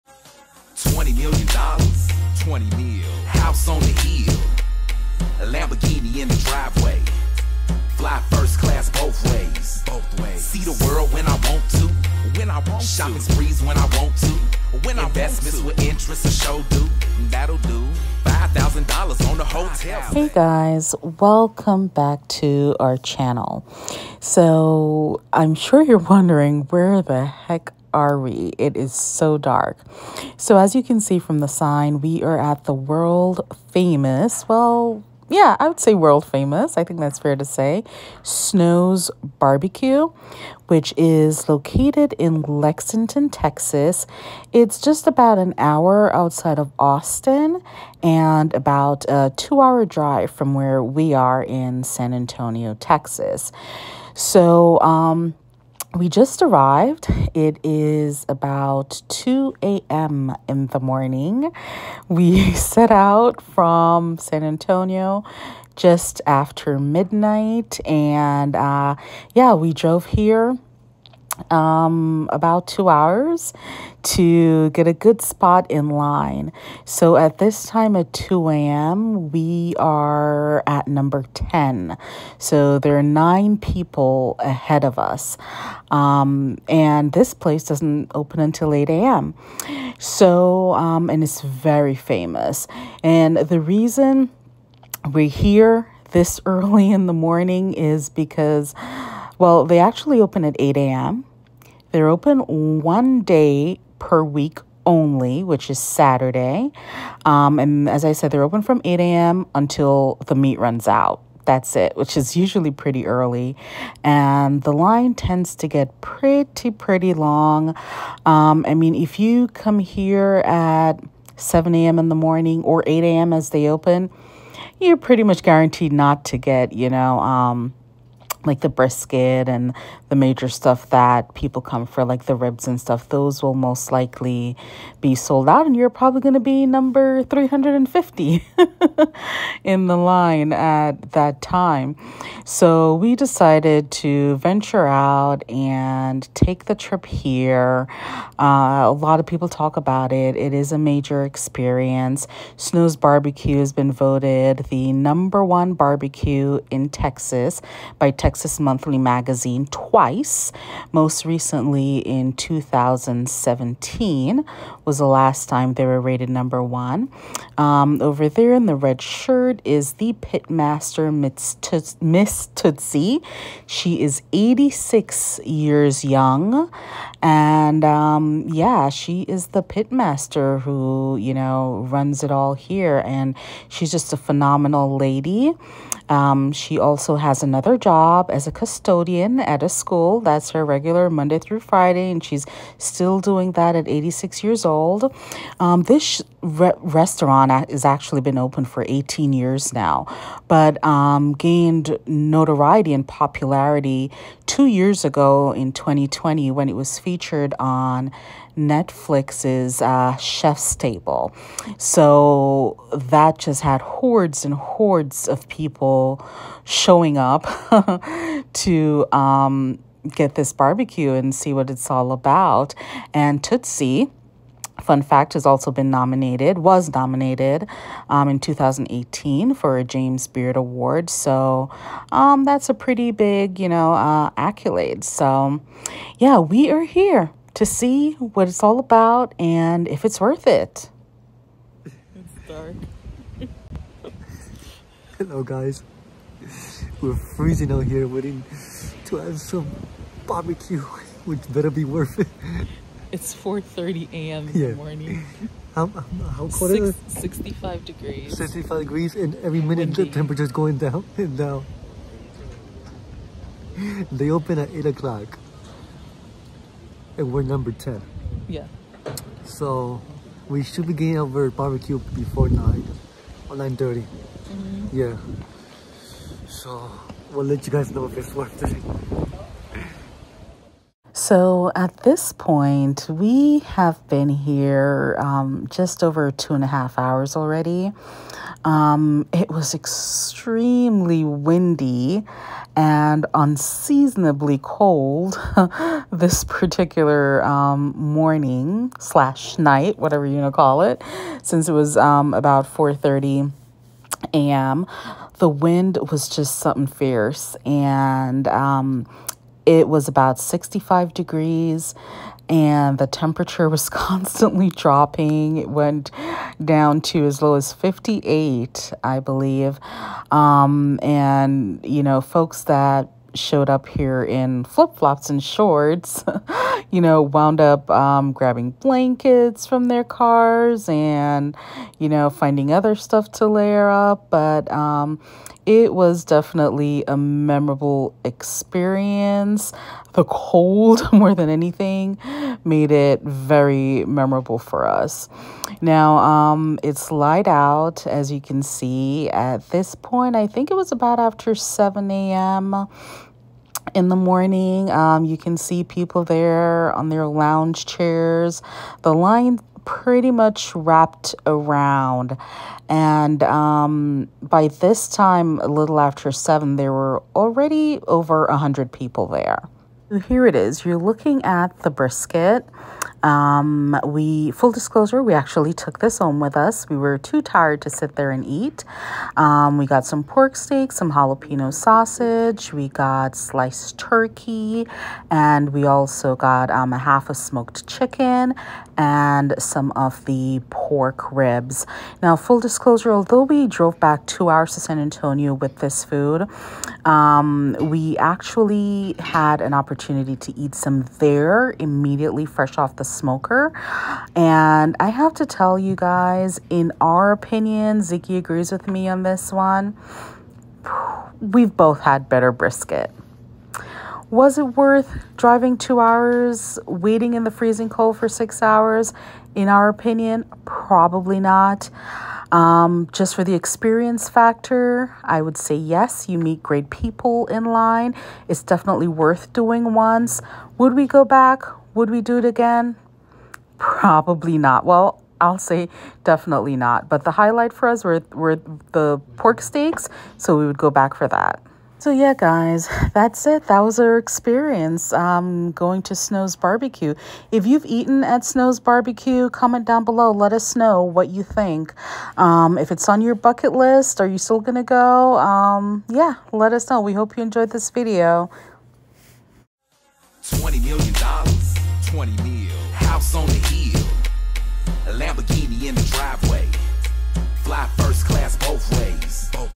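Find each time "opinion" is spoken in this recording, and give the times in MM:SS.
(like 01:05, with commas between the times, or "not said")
06:47, 06:59.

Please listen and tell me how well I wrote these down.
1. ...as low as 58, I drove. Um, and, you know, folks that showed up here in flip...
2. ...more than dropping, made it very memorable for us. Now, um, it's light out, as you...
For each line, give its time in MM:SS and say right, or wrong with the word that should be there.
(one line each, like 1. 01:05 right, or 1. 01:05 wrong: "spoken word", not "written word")
1. 05:17 wrong: "believe", not "drove"
2. 05:41 wrong: "anything", not "dropping".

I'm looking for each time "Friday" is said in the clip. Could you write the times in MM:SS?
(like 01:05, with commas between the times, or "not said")
03:11.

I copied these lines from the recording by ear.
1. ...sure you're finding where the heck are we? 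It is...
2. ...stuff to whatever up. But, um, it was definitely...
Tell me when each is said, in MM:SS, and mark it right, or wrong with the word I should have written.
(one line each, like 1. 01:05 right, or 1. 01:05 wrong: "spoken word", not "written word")
1. 00:25 wrong: "wondering", not "finding"
2. 05:32 wrong: "layer", not "whatever".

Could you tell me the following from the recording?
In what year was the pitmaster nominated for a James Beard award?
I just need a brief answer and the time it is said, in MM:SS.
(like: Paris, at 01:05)
2018, at 03:48.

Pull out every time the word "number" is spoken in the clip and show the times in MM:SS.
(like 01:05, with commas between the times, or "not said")
01:20, 02:16, 02:34, 02:46, 04:27.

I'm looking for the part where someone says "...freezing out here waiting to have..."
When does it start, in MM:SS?
04:07.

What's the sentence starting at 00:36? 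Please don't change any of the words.
I think that's fair to say.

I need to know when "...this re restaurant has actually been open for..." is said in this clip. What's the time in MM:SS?
03:15.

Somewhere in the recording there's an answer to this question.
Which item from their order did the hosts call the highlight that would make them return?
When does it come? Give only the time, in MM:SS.
07:19.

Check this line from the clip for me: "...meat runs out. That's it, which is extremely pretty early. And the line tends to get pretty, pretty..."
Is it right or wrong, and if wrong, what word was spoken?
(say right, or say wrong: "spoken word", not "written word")
wrong: "usually", not "extremely".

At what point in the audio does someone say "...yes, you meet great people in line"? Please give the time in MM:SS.
07:05.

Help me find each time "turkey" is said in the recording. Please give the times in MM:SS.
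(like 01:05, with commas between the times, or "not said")
06:23.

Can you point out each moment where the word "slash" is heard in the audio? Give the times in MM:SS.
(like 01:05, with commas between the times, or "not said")
04:58.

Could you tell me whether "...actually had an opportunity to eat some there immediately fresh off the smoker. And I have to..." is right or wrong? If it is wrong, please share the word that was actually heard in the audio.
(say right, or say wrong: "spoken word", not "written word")
right.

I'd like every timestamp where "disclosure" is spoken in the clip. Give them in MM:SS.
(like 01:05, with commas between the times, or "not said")
06:14, 06:32.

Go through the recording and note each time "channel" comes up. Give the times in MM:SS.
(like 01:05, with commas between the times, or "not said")
00:22.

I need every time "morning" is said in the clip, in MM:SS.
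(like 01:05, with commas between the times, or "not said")
01:00, 01:37, 02:02, 04:14, 04:57, 05:54.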